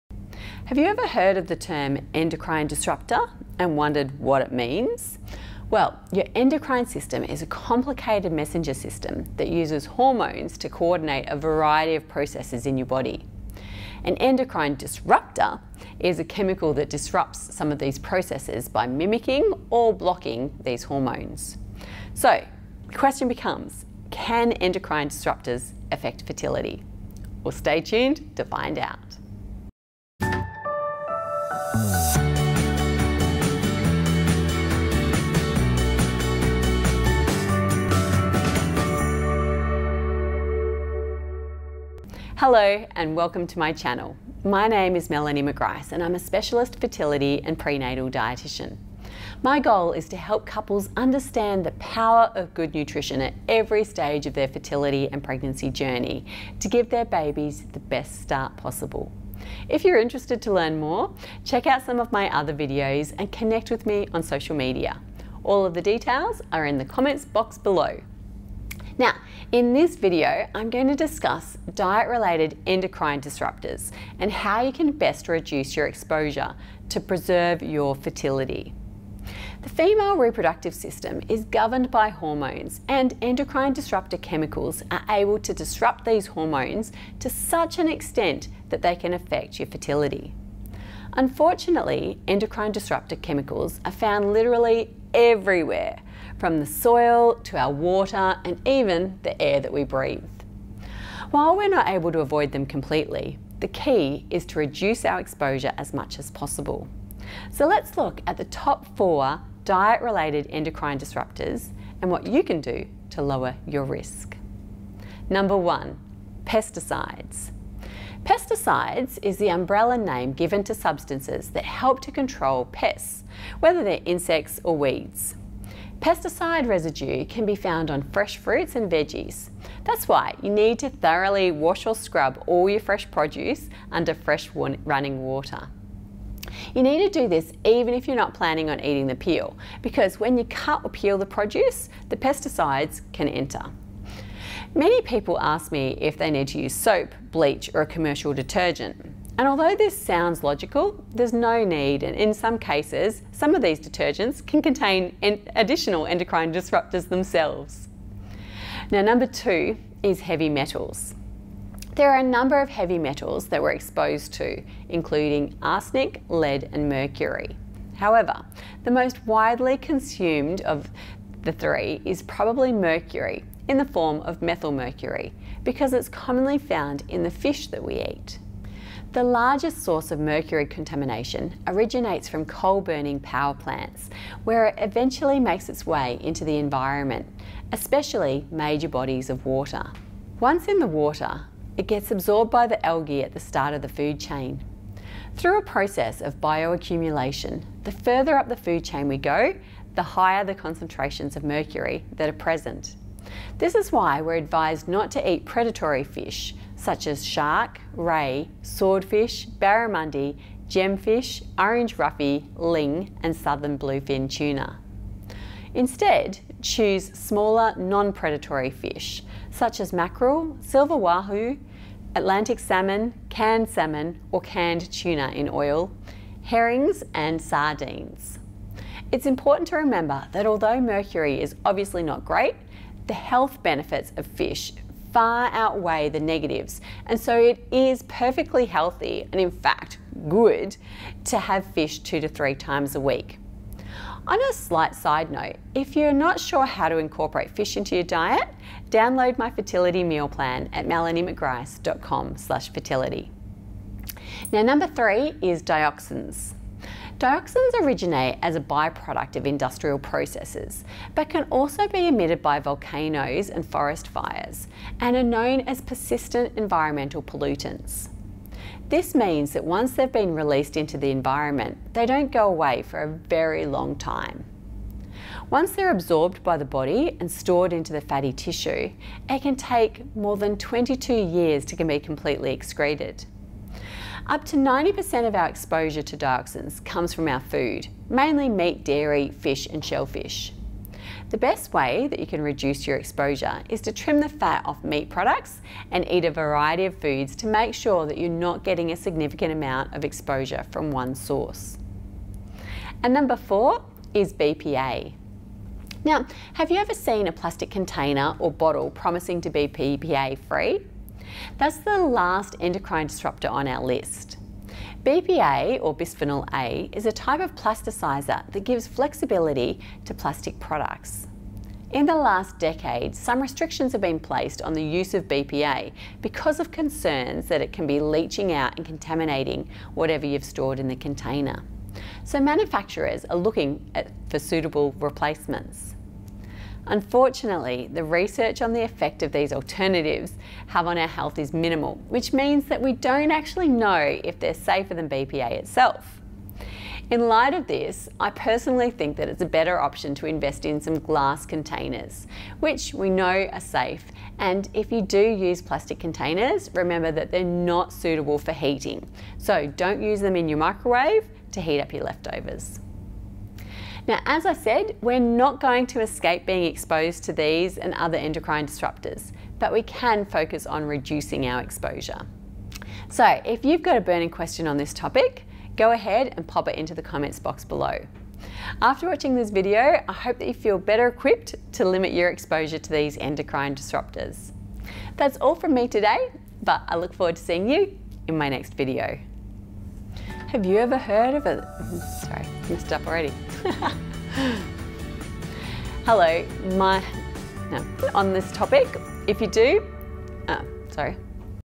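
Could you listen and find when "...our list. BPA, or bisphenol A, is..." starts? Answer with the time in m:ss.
5:13.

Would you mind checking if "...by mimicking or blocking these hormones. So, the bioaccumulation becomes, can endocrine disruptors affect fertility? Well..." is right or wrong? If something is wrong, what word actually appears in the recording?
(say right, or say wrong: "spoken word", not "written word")
wrong: "question", not "bioaccumulation".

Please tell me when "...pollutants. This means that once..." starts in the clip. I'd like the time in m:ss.
4:27.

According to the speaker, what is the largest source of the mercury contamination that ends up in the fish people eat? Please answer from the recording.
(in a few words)
Coal burning power plants.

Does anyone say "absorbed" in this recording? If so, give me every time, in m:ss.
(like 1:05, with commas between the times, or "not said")
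3:12, 4:35.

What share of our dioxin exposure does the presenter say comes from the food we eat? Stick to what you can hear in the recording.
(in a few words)
Up to 90%.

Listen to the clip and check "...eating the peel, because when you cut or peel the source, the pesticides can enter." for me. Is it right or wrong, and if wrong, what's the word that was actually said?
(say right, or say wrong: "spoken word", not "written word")
wrong: "produce", not "source".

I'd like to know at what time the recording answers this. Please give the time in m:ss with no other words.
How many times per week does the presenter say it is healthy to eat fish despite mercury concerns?
4:01.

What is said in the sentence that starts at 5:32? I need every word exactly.
So manufacturers are looking at, for suitable replacements.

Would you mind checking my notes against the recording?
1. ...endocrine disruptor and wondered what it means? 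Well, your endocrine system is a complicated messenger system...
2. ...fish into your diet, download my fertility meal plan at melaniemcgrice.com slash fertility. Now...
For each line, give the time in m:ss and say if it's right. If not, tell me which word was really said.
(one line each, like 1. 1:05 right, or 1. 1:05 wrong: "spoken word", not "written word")
1. 0:02 right
2. 4:07 right.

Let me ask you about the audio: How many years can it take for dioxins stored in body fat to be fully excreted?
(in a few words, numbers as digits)
22.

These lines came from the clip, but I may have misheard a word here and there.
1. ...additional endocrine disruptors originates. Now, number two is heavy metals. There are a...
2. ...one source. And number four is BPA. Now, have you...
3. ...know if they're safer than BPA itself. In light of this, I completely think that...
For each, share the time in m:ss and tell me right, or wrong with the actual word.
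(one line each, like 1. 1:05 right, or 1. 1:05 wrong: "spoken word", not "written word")
1. 2:35 wrong: "themselves", not "originates"
2. 5:00 right
3. 5:43 wrong: "personally", not "completely".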